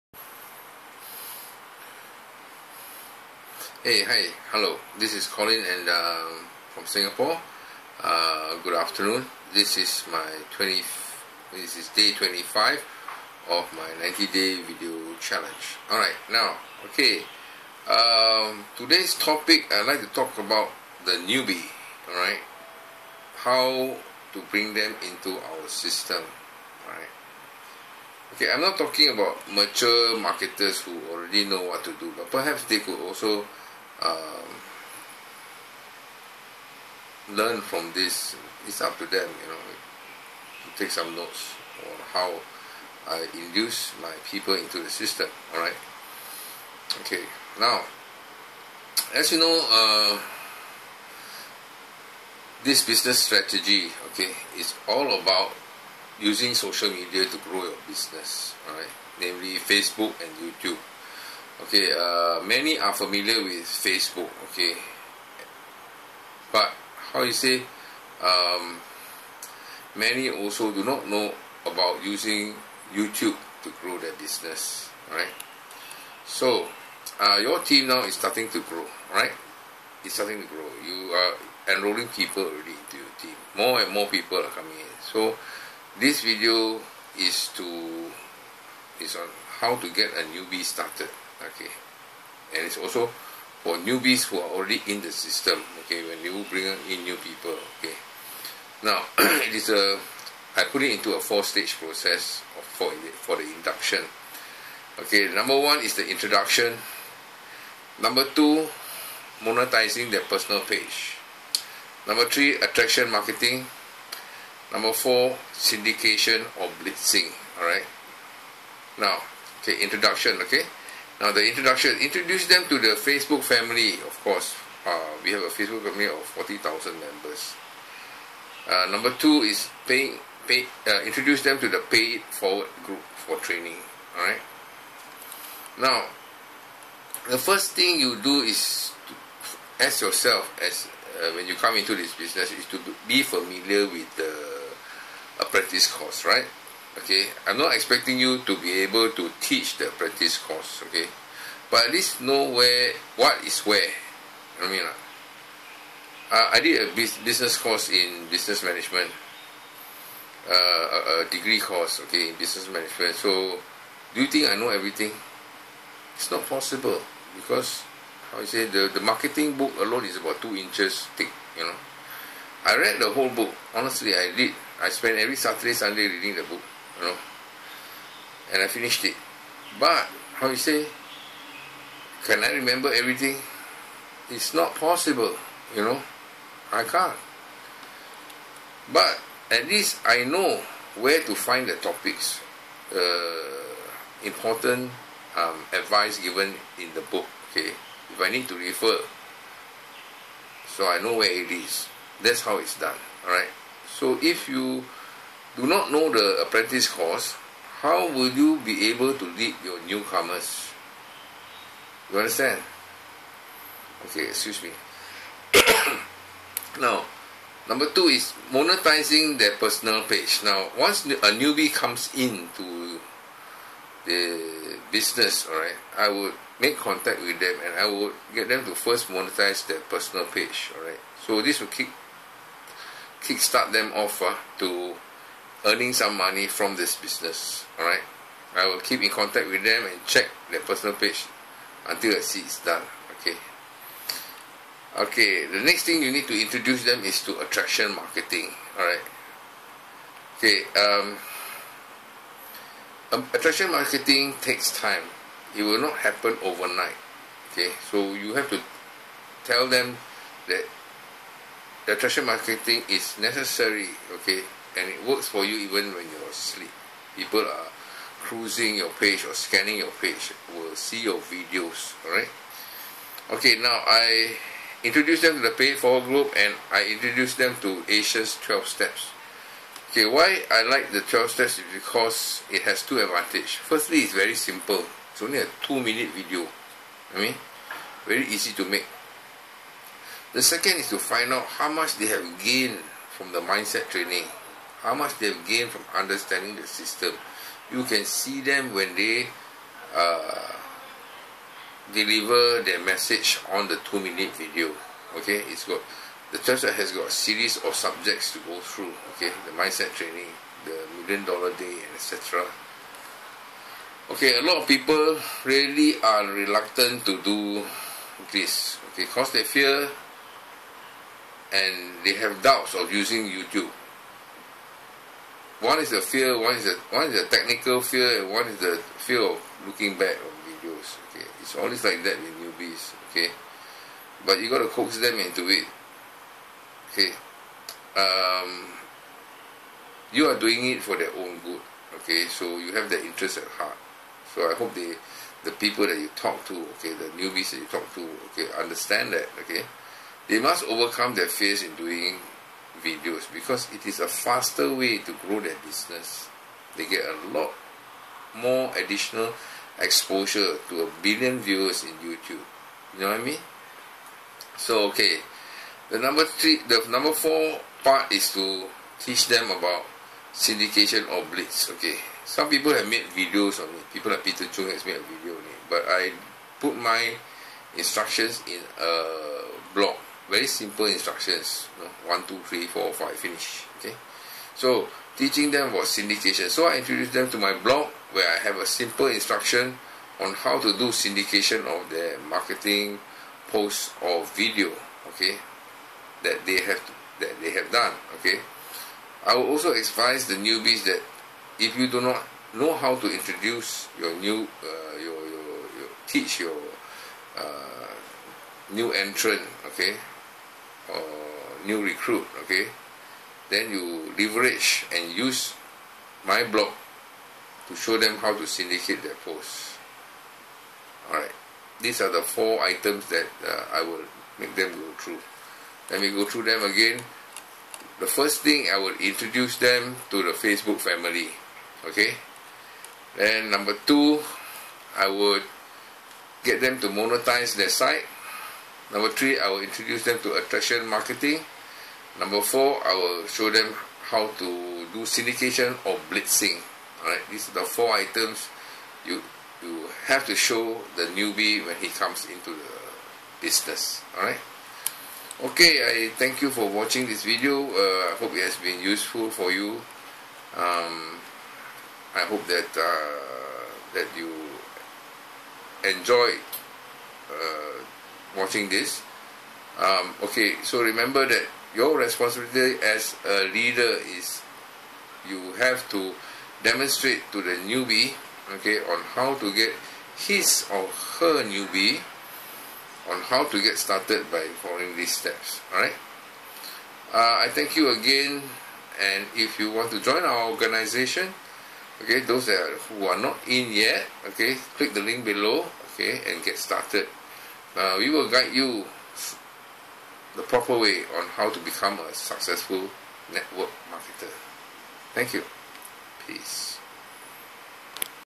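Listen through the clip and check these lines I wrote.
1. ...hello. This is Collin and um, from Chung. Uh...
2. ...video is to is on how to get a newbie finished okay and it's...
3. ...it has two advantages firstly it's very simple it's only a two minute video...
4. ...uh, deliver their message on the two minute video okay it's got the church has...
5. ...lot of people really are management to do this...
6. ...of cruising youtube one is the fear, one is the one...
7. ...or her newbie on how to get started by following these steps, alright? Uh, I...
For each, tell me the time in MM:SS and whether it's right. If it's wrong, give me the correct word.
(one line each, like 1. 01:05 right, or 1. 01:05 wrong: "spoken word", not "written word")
1. 00:04 wrong: "Singapore", not "Chung"
2. 01:26 wrong: "started", not "finished"
3. 04:42 right
4. 04:59 right
5. 05:14 wrong: "reluctant", not "management"
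6. 05:22 wrong: "using", not "cruising"
7. 08:00 right.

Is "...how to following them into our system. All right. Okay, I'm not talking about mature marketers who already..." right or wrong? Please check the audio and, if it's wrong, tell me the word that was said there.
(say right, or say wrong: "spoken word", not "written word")
wrong: "bring", not "following".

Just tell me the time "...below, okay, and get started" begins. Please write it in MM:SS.
08:15.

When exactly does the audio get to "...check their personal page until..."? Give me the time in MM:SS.
04:00.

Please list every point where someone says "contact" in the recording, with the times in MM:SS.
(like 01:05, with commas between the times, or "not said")
03:46, 03:59.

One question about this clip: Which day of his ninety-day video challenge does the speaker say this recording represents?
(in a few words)
25.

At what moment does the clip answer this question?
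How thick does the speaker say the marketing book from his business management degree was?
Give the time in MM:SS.
02:50.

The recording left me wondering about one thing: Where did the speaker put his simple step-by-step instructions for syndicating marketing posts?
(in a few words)
A blog.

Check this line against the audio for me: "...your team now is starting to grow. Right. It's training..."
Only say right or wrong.
wrong.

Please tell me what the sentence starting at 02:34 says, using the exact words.
I mean, uh, I did a business course in business management, uh, a, a degree course, okay, in business management.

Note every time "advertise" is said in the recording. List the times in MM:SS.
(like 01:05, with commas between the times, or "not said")
not said.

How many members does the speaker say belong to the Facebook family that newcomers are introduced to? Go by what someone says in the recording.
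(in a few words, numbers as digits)
40,000.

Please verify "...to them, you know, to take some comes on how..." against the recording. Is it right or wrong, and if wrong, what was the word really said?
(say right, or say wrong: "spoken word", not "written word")
wrong: "notes", not "comes".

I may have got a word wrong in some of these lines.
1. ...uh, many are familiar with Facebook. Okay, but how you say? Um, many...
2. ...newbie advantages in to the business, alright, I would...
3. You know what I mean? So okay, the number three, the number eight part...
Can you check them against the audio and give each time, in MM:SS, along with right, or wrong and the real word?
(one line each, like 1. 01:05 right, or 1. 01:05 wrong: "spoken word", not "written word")
1. 01:01 right
2. 03:41 wrong: "comes", not "advantages"
3. 06:02 wrong: "four", not "eight".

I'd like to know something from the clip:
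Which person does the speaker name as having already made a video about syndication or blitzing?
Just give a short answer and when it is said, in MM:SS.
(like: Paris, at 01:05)
Peter Chung, at 06:14.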